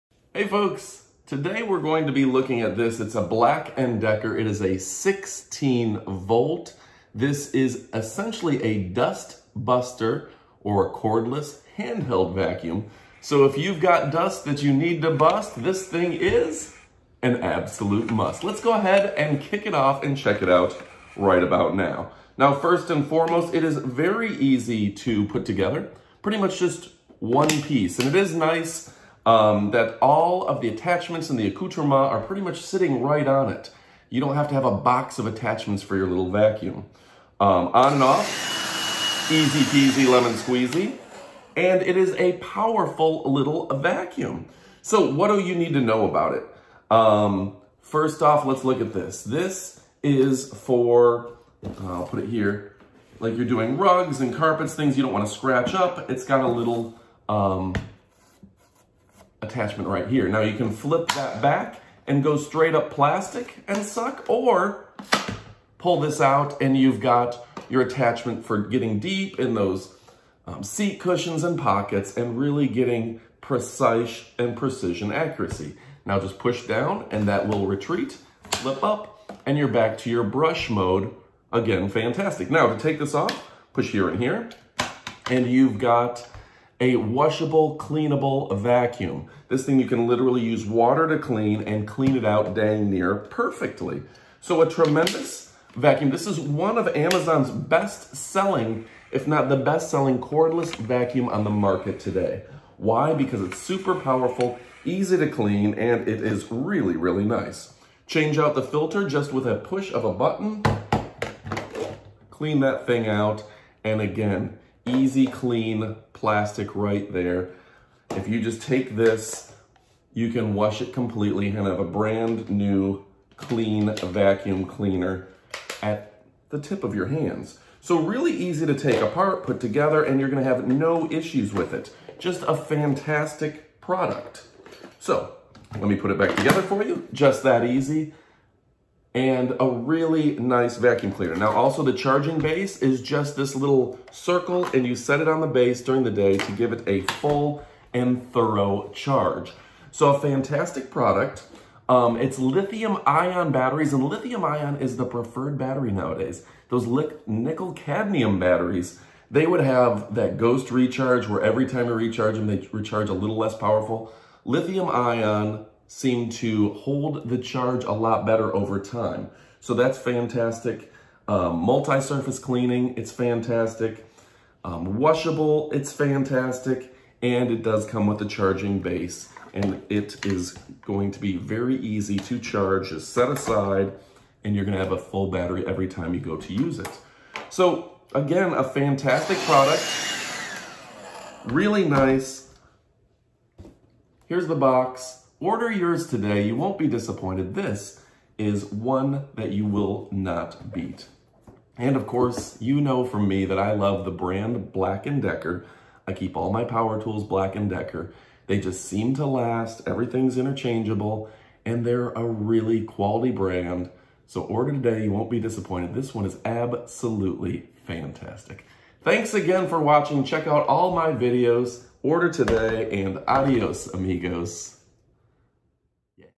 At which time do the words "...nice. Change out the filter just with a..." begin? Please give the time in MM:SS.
01:47.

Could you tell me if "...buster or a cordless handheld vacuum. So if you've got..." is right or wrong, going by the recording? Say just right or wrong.
right.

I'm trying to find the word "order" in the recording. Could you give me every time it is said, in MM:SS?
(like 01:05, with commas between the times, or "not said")
03:15, 03:34, 03:42.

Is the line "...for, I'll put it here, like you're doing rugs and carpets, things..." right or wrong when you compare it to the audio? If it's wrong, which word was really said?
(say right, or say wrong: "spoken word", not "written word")
right.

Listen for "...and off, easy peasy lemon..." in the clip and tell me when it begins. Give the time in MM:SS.
00:37.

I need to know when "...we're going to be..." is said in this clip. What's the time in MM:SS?
00:01.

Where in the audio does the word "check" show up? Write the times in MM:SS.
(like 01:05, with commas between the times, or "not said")
00:20, 03:40.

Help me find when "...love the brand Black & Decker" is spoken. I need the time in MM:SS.
03:23.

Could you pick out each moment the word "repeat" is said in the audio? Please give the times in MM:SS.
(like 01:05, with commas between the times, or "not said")
not said.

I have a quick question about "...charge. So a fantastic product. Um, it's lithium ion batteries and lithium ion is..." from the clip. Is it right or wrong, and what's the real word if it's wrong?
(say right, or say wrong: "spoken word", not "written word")
right.